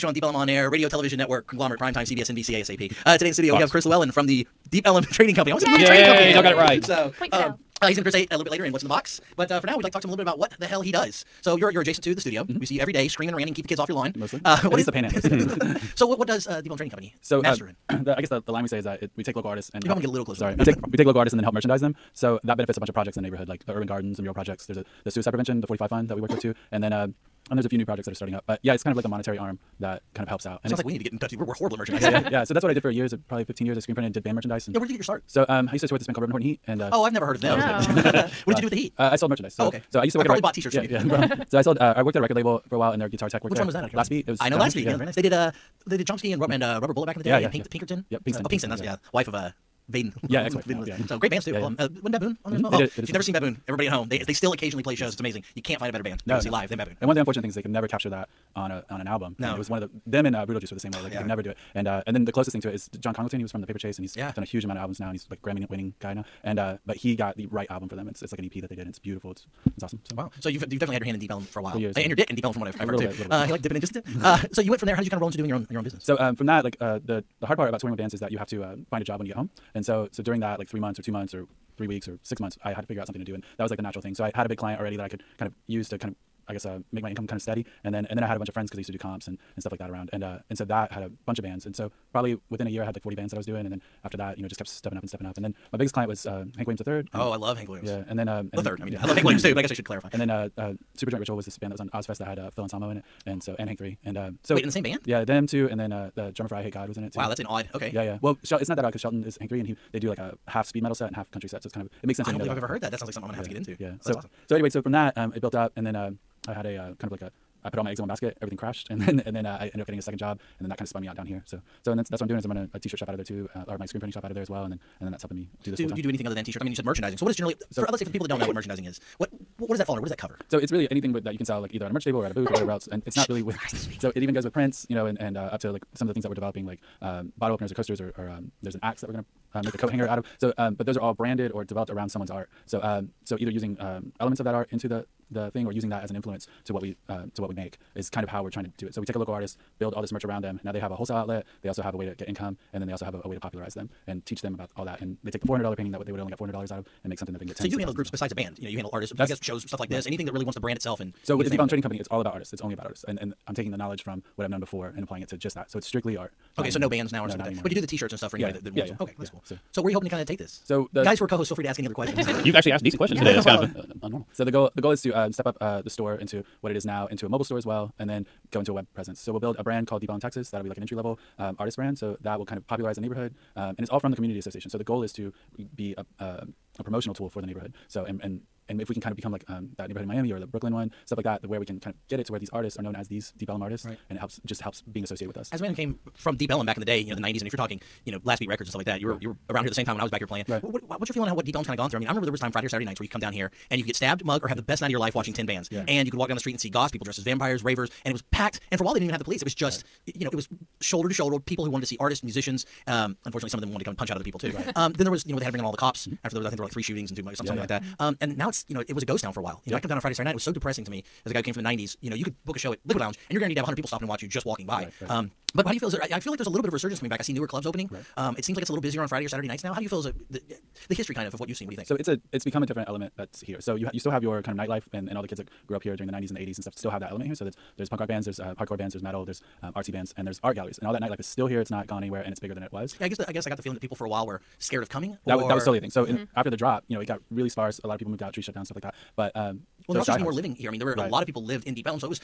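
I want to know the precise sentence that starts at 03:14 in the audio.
And it helps just helps being associated with us.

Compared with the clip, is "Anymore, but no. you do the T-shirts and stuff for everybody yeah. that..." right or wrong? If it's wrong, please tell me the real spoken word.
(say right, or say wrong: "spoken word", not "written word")
wrong: "anybody", not "everybody".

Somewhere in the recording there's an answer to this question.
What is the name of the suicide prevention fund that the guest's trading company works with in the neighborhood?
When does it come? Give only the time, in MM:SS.
00:25.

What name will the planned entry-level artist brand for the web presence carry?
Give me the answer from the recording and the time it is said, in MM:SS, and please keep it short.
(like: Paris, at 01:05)
Deep Ellum Texas, at 02:59.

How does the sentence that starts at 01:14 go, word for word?
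How did you kind of roll into doing your own your own business?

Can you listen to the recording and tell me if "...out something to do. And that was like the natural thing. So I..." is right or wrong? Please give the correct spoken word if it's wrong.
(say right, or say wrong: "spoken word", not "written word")
right.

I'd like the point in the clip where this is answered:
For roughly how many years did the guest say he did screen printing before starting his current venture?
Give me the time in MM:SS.
00:33.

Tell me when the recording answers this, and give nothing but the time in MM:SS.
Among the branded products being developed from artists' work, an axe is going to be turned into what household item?
02:19.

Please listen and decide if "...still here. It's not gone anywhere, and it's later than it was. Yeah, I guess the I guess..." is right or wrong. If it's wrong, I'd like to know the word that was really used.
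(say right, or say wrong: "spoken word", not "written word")
wrong: "bigger", not "later".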